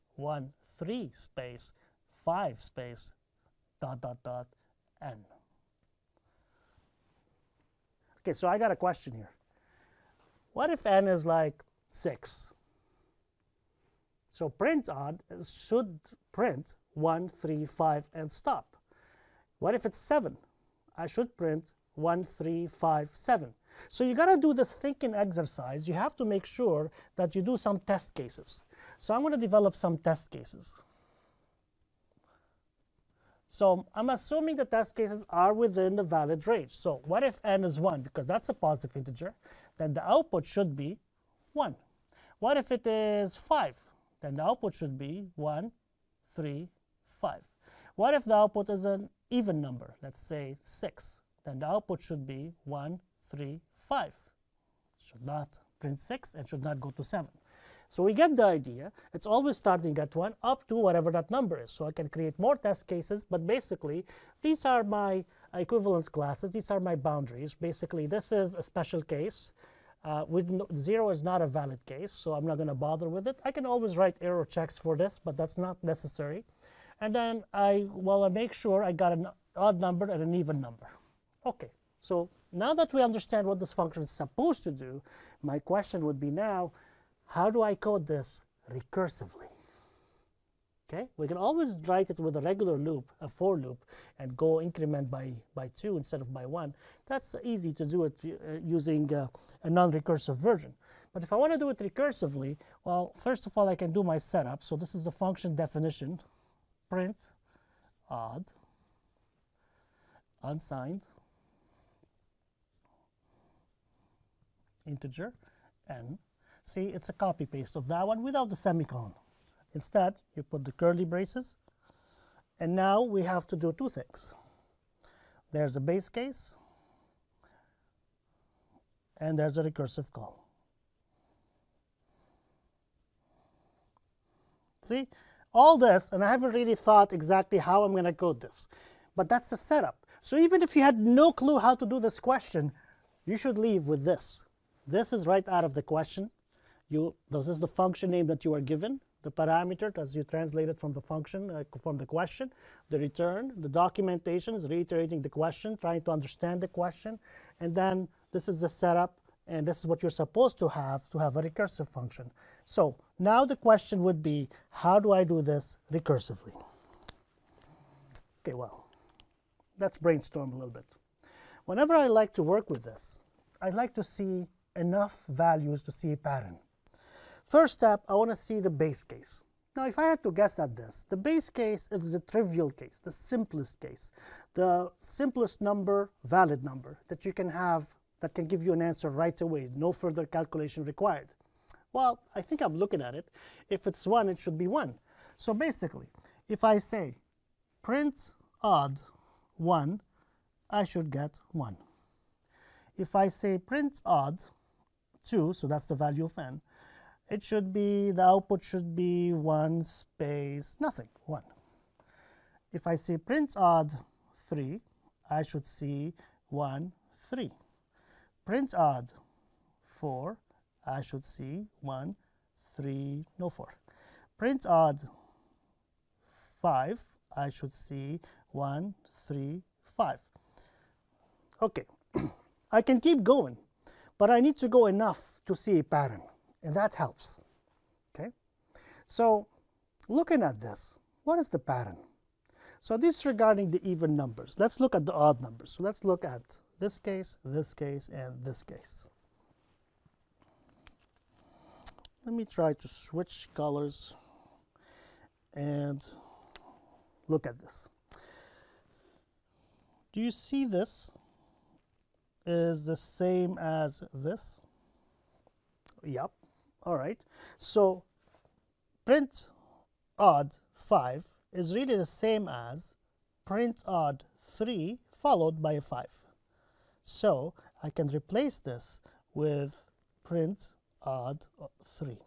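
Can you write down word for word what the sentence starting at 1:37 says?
That's easy to do it uh, using uh, a non-recursive version.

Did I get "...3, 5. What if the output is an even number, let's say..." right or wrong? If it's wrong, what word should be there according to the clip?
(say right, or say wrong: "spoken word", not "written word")
right.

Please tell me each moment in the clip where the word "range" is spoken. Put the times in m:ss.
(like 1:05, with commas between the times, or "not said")
0:36.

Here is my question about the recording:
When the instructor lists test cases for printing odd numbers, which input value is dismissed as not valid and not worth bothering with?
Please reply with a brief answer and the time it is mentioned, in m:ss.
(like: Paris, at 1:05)
0, at 1:10.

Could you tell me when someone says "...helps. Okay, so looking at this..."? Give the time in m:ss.
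3:56.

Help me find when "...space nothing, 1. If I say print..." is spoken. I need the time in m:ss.
3:29.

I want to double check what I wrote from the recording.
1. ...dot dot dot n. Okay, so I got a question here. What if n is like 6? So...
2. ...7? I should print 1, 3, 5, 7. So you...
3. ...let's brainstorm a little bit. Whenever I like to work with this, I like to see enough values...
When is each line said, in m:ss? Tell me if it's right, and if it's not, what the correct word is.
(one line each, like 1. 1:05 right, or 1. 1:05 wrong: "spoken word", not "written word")
1. 0:03 right
2. 0:20 right
3. 2:49 right.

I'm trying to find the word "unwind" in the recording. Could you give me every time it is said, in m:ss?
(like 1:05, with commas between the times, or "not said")
not said.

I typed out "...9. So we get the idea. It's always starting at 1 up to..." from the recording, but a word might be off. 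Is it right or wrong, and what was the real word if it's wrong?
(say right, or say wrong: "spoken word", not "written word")
wrong: "7", not "9".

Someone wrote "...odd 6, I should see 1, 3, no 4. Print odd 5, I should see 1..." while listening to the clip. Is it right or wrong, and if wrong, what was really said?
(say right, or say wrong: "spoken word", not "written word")
wrong: "4", not "6".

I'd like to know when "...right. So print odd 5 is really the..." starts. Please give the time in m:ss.
4:26.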